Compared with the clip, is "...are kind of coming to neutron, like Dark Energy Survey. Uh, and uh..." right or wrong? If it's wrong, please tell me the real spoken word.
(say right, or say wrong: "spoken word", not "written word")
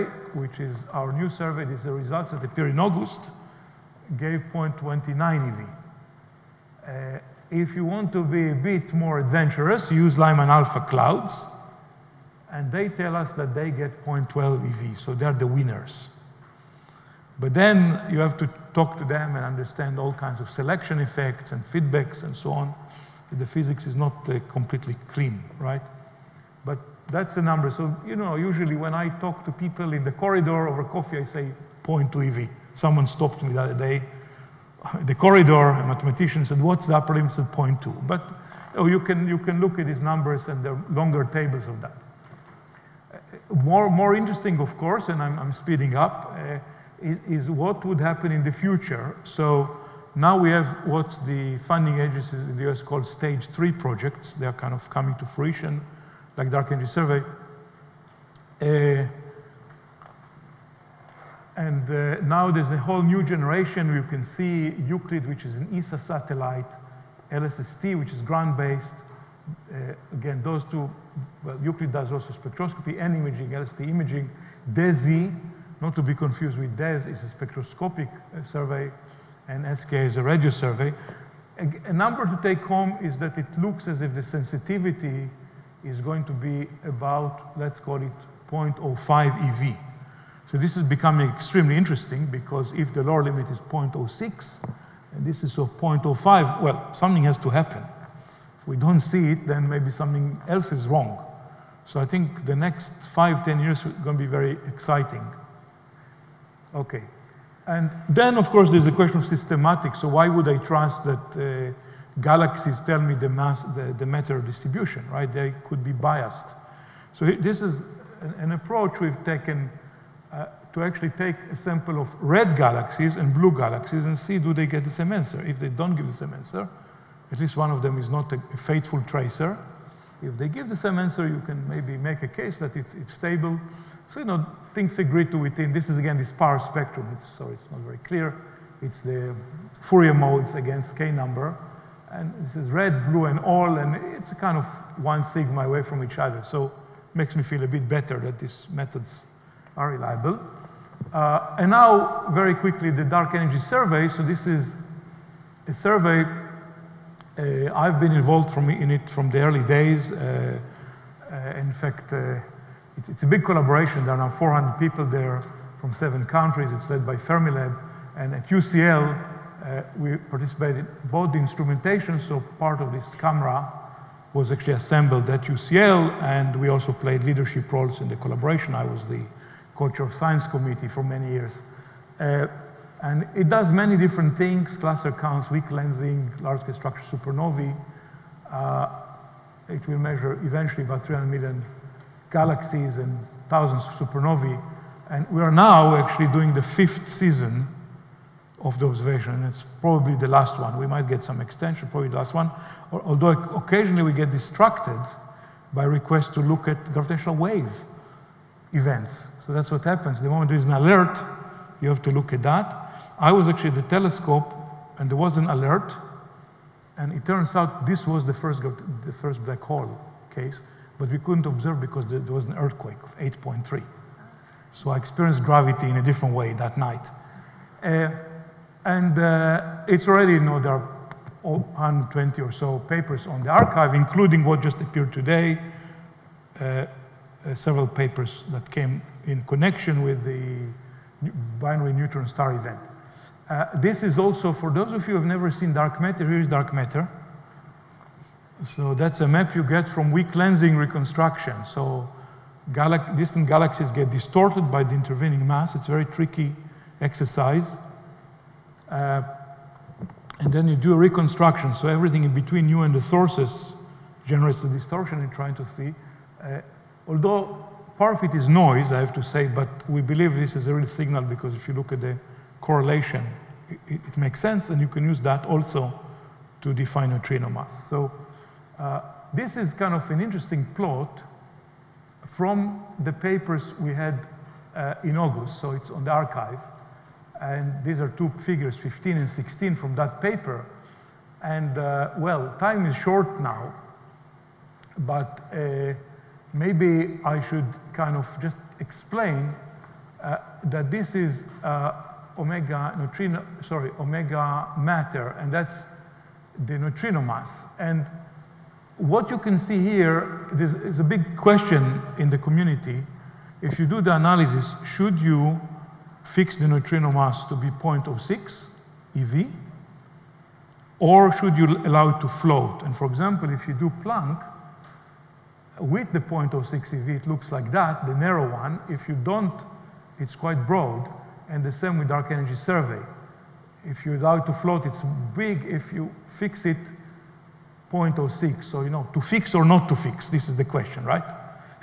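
wrong: "fruition", not "neutron".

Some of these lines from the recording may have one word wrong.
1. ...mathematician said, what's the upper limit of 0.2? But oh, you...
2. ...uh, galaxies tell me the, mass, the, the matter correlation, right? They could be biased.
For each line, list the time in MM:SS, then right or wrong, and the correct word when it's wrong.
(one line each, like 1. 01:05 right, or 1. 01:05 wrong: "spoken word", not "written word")
1. 00:35 right
2. 01:51 wrong: "distribution", not "correlation".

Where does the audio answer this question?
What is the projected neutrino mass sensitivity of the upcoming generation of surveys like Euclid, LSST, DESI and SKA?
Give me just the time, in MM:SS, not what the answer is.
01:28.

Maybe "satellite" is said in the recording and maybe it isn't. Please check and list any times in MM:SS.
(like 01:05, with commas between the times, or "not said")
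01:05.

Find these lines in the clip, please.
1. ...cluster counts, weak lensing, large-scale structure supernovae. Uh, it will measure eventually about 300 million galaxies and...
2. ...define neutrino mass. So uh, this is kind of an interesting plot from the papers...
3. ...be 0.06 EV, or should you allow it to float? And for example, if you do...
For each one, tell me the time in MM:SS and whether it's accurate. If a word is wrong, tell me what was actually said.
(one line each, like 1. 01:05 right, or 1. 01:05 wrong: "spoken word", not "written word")
1. 03:04 right
2. 04:36 right
3. 05:17 right.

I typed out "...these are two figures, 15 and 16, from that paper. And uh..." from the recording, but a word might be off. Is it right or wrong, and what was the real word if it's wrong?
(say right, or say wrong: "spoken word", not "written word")
right.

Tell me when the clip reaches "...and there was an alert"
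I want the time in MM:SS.
03:34.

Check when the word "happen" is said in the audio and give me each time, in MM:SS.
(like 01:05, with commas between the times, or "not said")
00:47, 01:37, 03:29.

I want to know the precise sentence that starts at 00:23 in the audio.
The physics is not uh, completely clean, right?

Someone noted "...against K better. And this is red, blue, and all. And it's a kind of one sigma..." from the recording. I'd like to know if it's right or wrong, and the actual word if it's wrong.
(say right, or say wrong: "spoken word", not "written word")
wrong: "number", not "better".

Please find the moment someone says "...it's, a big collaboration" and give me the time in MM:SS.
02:43.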